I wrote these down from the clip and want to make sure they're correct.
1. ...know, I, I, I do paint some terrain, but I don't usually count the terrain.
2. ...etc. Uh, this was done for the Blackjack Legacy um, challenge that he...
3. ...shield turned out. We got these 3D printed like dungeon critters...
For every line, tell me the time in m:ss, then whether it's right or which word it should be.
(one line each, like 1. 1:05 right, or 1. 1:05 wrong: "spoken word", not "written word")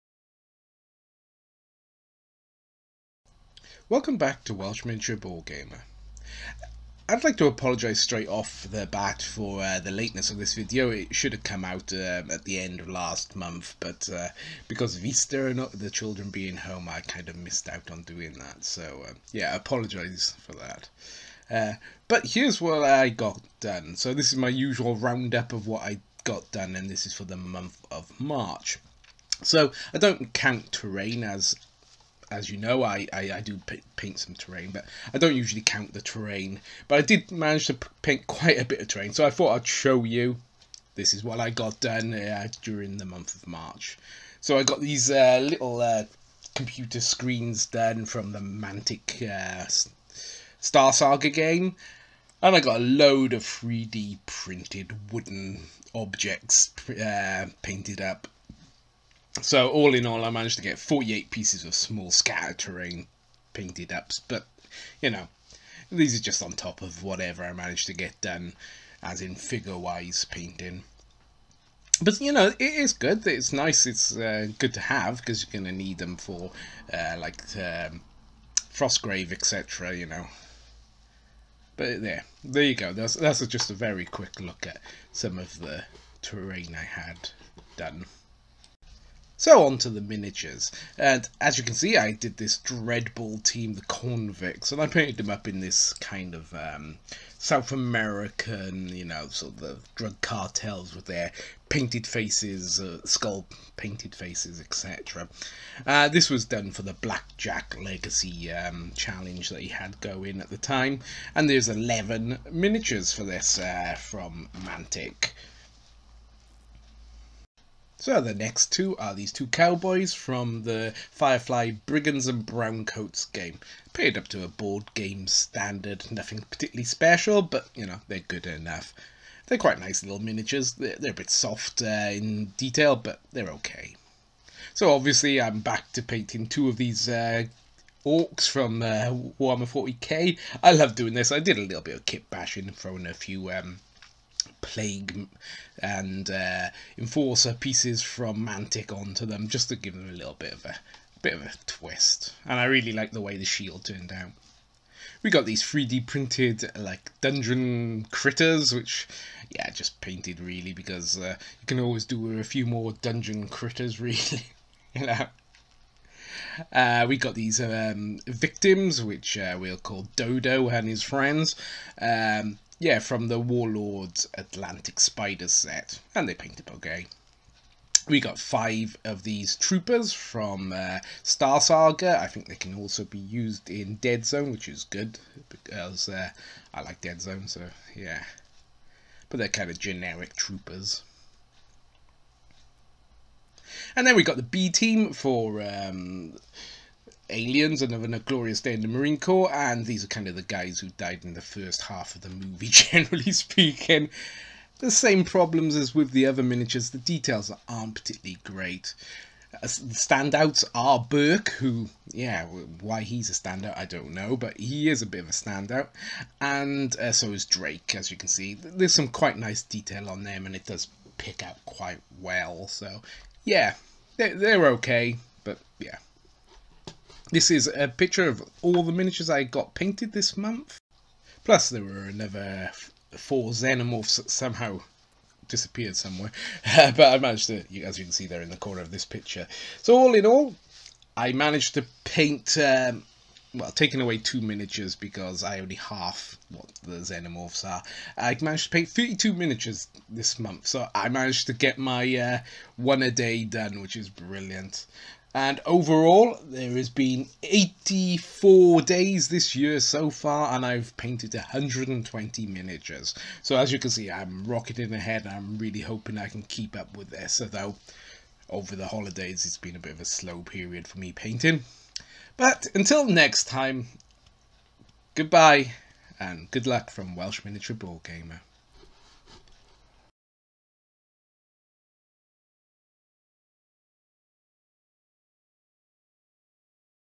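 1. 0:32 right
2. 1:44 right
3. 2:33 right.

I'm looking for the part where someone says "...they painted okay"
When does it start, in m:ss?
2:56.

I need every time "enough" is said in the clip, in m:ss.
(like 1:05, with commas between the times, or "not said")
2:08.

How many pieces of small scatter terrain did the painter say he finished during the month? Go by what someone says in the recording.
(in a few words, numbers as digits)
48.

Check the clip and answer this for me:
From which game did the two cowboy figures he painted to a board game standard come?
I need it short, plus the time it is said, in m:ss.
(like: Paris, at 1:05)
Firefly Brigands and Browncoats, at 2:01.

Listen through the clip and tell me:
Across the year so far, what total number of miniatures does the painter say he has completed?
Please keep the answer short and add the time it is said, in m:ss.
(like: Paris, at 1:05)
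120, at 4:21.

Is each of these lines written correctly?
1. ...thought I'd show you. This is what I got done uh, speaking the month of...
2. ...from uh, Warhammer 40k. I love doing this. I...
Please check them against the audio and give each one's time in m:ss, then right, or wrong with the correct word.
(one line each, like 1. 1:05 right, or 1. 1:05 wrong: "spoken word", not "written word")
1. 0:39 wrong: "during", not "speaking"
2. 2:18 right.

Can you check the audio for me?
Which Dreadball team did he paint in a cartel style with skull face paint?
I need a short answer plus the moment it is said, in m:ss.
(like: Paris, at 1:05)
The Convicts, at 1:33.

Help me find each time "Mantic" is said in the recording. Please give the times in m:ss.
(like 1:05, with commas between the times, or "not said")
0:48, 1:54, 2:28.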